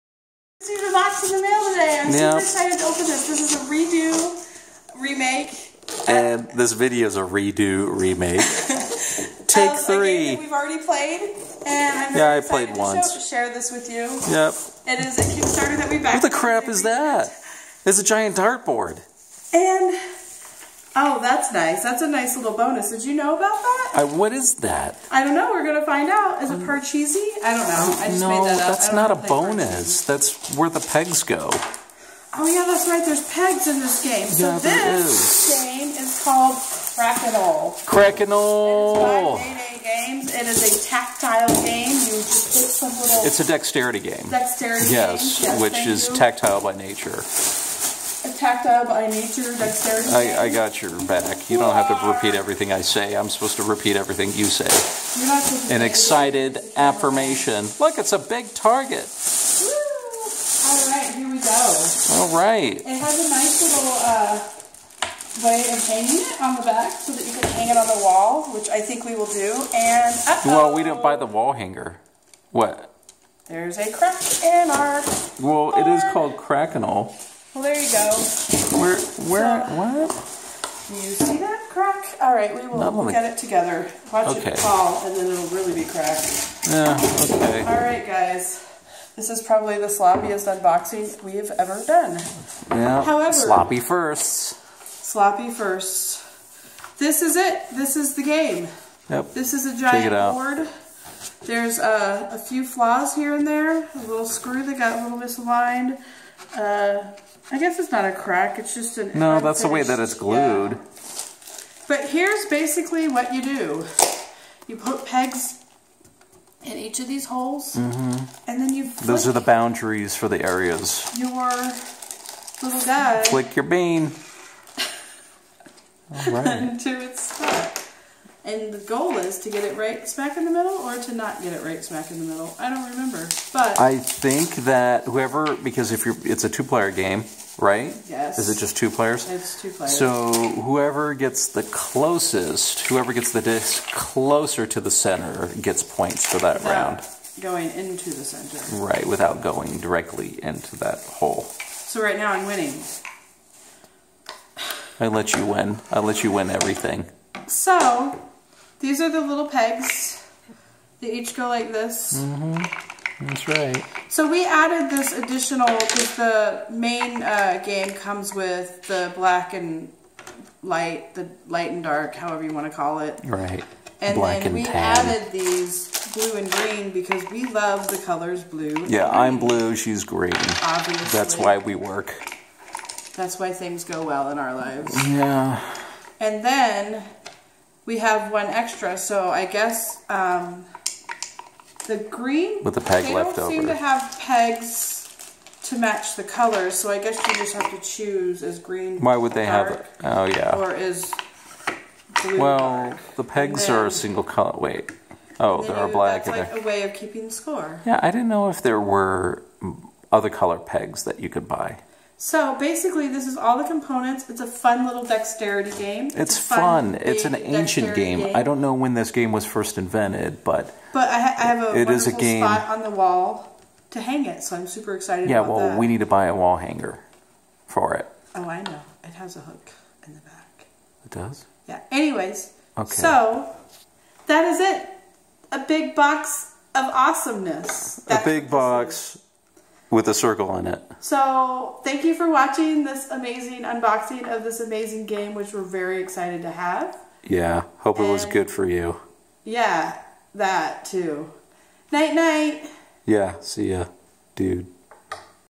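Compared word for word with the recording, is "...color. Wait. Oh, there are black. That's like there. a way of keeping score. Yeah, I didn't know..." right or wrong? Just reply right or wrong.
right.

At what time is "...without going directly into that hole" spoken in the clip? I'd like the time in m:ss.
2:29.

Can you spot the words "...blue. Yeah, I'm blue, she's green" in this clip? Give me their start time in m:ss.
2:58.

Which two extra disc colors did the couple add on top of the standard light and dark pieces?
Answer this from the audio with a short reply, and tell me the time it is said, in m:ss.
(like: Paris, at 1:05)
Blue and green, at 2:54.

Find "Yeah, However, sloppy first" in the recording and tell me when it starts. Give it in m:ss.
1:32.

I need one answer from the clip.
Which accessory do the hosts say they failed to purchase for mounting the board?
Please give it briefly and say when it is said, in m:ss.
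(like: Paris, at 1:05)
The wall hanger, at 1:10.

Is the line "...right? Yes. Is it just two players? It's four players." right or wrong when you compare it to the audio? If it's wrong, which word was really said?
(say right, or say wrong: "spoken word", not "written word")
wrong: "two", not "four".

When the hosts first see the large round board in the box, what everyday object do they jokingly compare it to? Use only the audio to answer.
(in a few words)
A giant dartboard.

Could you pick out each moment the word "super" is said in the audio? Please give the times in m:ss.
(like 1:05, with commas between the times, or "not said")
0:02, 3:44.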